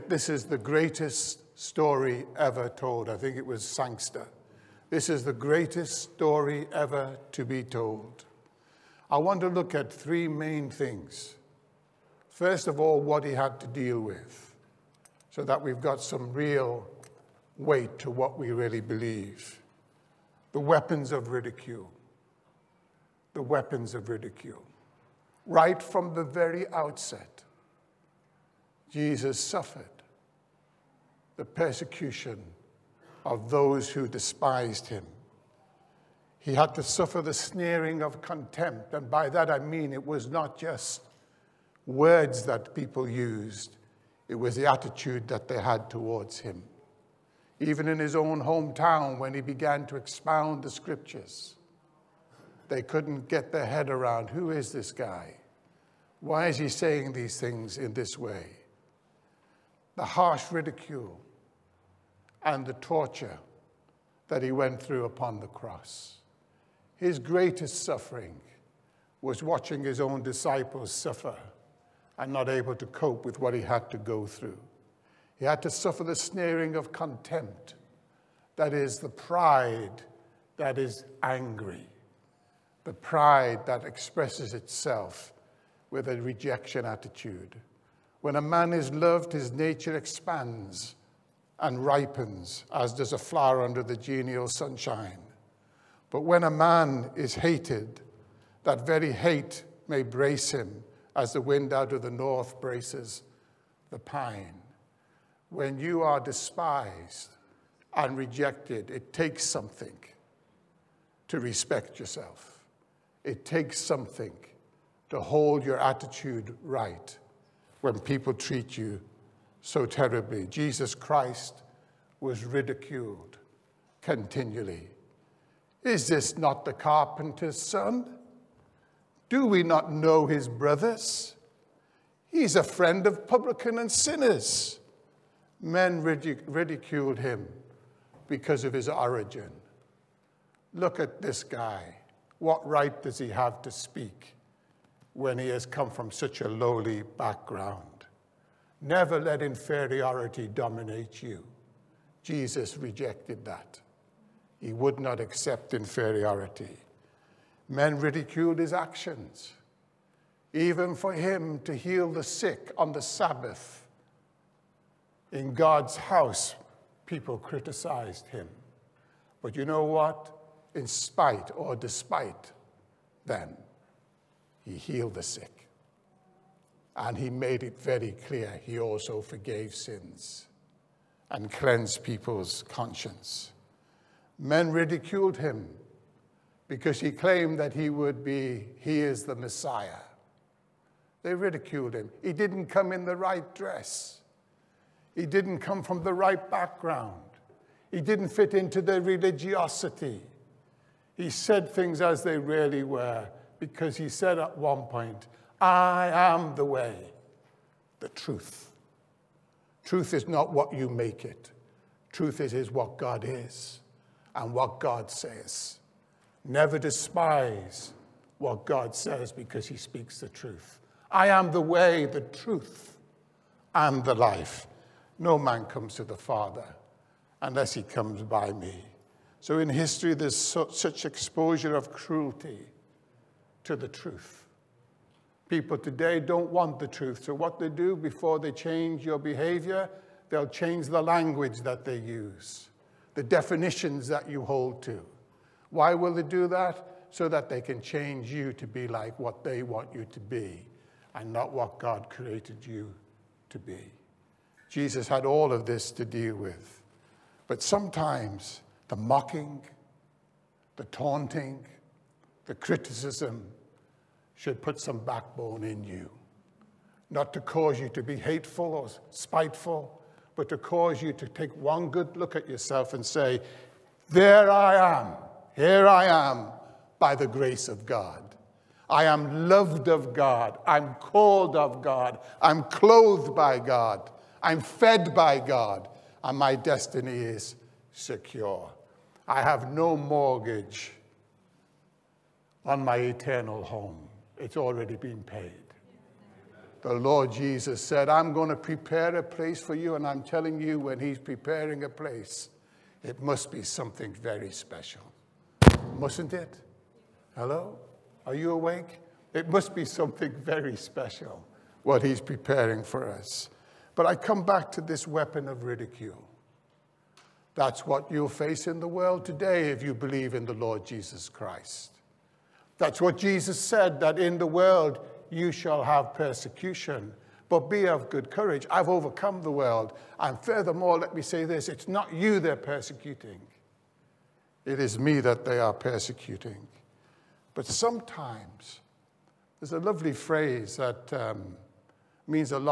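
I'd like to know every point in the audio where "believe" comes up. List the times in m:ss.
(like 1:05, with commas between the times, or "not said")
0:18, 5:19.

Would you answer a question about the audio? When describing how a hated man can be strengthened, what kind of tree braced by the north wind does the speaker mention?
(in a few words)
pine.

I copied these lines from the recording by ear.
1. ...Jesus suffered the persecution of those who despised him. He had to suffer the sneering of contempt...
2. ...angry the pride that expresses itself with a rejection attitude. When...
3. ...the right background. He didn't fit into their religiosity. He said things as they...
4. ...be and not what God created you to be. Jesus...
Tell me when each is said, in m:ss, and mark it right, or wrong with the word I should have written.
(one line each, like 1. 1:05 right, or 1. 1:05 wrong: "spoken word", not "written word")
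1. 0:28 right
2. 1:21 right
3. 3:16 right
4. 4:10 right.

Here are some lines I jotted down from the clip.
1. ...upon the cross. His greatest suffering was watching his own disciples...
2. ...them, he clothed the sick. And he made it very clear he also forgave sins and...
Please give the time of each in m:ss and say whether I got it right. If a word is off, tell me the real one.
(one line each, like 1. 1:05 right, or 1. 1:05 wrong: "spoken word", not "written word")
1. 1:05 right
2. 2:53 wrong: "healed", not "clothed".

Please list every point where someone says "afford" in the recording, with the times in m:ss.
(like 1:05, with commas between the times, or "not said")
not said.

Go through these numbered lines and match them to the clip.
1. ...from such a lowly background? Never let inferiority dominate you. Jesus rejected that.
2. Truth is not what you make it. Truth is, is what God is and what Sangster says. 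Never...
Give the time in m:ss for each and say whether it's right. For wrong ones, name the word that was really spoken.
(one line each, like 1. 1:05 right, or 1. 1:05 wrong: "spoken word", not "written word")
1. 2:25 right
2. 3:29 wrong: "God", not "Sangster".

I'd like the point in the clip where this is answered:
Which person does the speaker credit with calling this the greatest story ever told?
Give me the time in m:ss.
0:03.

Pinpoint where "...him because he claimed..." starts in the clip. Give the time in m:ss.
3:05.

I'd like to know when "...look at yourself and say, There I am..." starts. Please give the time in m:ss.
4:32.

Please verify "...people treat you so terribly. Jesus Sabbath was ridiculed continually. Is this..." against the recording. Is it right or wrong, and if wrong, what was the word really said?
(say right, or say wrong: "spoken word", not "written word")
wrong: "Christ", not "Sabbath".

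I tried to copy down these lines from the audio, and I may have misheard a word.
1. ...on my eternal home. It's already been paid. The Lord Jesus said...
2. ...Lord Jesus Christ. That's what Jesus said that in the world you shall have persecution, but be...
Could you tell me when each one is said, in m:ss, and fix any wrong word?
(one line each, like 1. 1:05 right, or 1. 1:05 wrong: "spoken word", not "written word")
1. 4:52 right
2. 5:20 right.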